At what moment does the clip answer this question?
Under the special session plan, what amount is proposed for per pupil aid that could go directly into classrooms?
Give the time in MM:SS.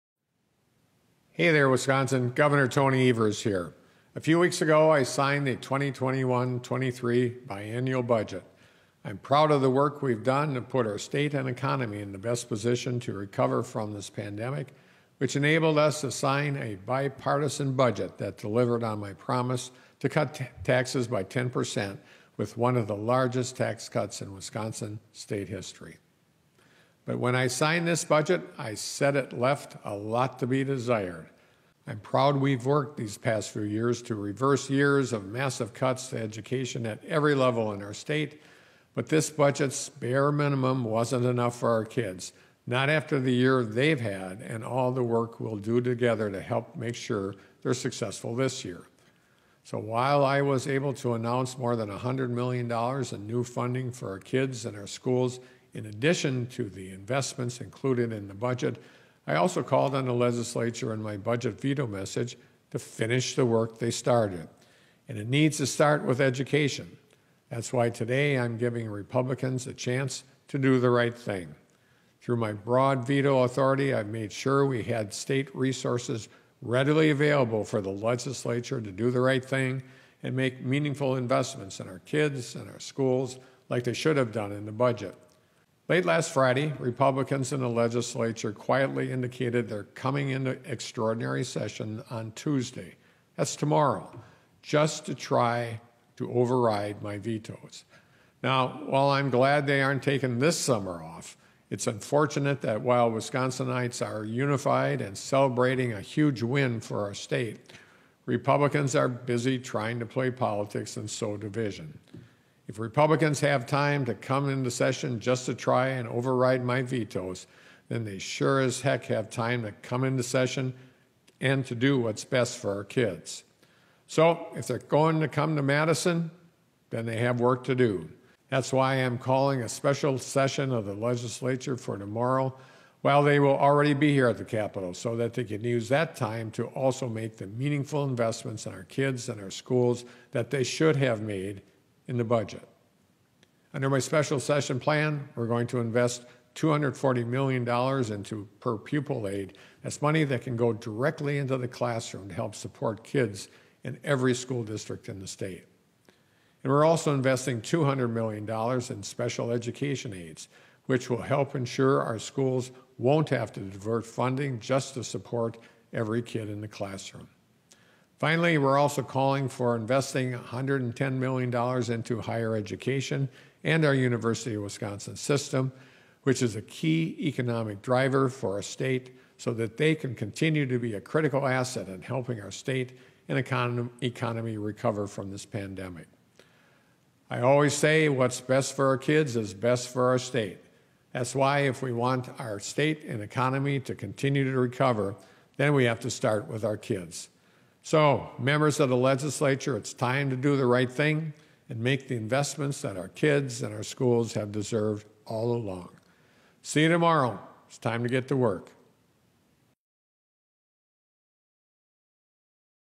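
02:26.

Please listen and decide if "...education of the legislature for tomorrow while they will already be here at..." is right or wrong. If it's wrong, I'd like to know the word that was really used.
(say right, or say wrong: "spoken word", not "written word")
wrong: "session", not "education".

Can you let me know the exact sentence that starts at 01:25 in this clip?
Late last Friday, Republicans in the legislature quietly indicated they're coming into extraordinary session on Tuesday.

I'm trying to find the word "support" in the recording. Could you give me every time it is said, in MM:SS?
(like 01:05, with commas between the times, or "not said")
02:32, 02:45.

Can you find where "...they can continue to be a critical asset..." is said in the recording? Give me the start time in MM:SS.
02:59.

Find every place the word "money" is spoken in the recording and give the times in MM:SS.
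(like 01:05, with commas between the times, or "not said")
02:30.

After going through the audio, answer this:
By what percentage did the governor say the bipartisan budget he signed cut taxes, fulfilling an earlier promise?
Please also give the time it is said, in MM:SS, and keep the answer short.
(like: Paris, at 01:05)
10%, at 00:21.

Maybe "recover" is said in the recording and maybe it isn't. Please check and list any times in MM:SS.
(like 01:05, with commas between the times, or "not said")
00:13, 03:04, 03:14.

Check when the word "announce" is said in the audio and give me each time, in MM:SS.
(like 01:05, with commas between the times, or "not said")
00:51.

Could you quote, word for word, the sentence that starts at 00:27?
But when I signed this budget, I said it left a lot to be desired.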